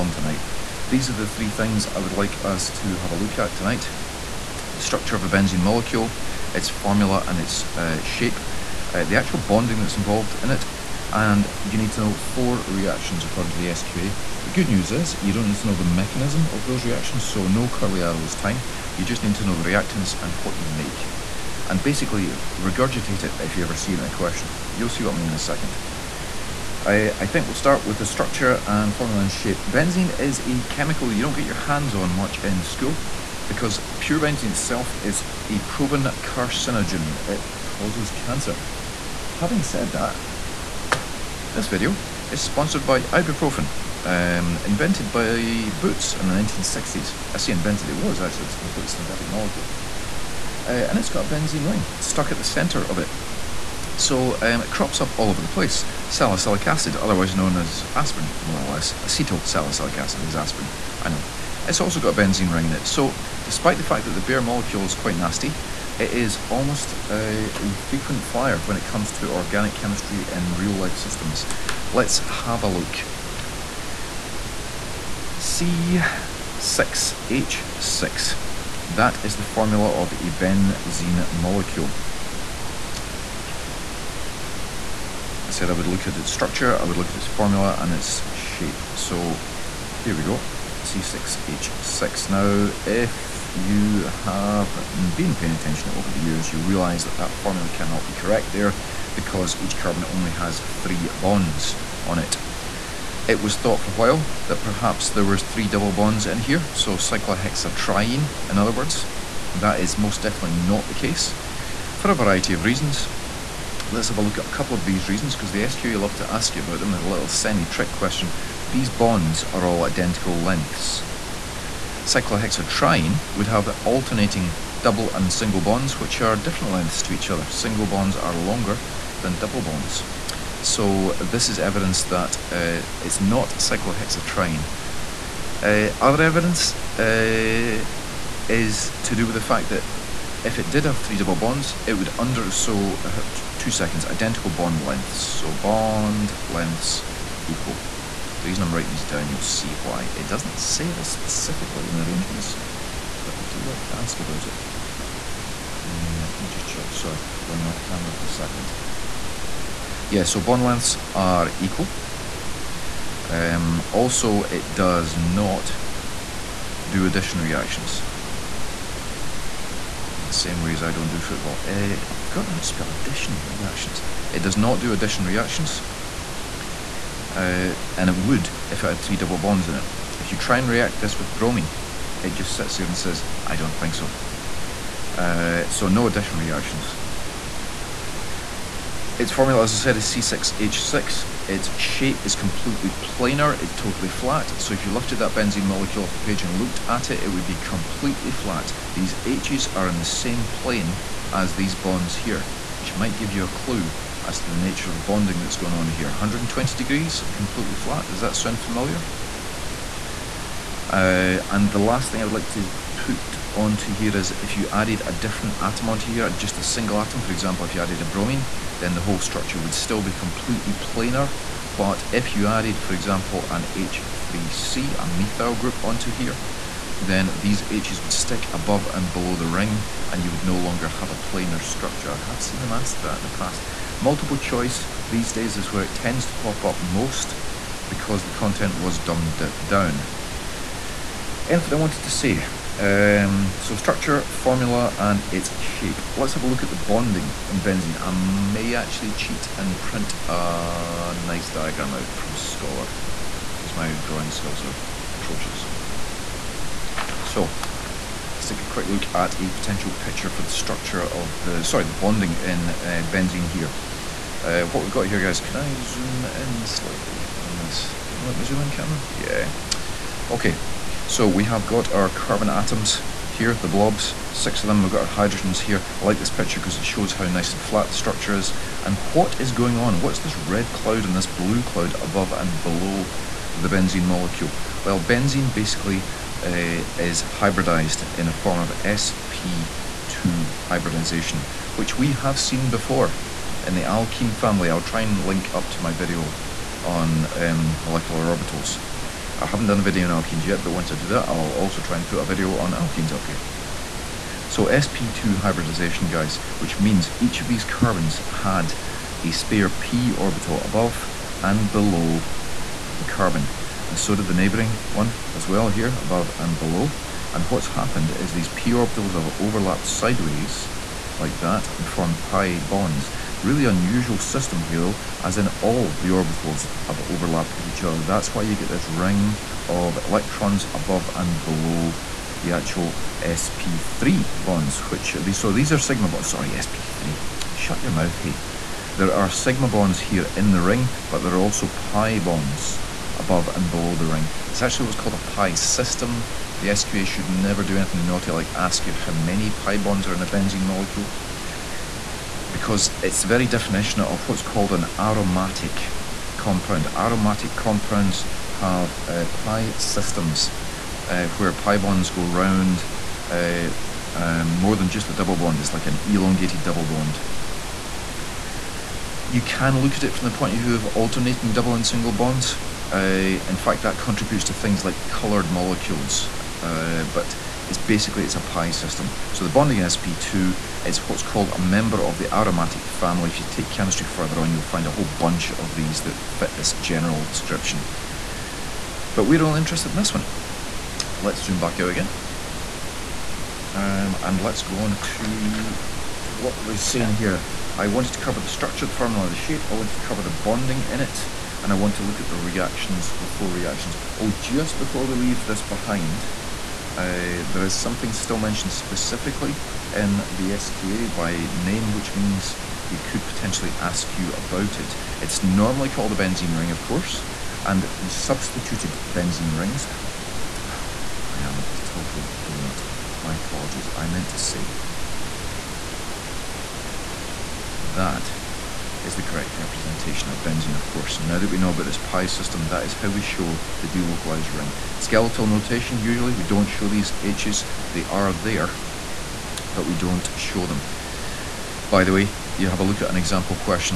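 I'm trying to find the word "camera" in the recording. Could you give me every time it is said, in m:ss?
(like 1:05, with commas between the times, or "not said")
2:37, 4:28.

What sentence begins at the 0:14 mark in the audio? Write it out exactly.
The good news is you don't need to know the mechanism of those reactions, so no curly arrows time.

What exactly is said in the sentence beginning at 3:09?
Its formula, as I said, is C6H6.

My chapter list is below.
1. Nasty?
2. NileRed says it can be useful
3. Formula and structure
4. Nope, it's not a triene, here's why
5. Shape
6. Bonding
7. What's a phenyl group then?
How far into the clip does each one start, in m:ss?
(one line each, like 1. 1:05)
1. 0:27
2. 0:39
3. 1:10
4. 1:41
5. 3:10
6. 4:15
7. 6:45.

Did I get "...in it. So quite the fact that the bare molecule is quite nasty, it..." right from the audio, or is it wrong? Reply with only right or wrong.
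wrong.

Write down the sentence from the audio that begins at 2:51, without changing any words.
Uh, I've forgotten how to spell addition reactions.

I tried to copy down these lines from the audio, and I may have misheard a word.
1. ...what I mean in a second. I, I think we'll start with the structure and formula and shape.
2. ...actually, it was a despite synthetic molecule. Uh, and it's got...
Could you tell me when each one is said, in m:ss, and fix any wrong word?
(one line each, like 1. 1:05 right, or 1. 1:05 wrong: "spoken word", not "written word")
1. 0:25 right
2. 0:48 wrong: "complete", not "despite".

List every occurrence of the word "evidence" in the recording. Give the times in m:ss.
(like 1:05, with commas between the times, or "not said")
2:11, 2:16.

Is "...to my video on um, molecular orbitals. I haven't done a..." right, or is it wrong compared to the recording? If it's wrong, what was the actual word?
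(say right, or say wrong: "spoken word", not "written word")
right.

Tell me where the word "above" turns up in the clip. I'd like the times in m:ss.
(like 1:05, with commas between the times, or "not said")
3:48, 4:42, 5:10, 5:16, 5:30, 5:43.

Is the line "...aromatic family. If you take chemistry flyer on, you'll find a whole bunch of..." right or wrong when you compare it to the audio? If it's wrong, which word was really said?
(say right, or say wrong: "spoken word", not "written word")
wrong: "further", not "flyer".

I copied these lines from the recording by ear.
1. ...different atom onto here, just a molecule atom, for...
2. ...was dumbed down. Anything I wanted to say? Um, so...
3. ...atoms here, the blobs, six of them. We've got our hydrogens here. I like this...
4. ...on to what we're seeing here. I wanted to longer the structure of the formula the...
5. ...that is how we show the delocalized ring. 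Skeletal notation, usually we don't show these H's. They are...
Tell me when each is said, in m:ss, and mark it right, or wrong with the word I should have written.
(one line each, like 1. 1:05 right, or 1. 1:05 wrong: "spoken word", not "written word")
1. 3:35 wrong: "single", not "molecule"
2. 3:58 right
3. 4:32 right
4. 6:34 wrong: "cover", not "longer"
5. 7:12 right.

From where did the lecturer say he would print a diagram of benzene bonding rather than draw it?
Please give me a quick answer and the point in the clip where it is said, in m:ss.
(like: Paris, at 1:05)
Scholar, at 4:12.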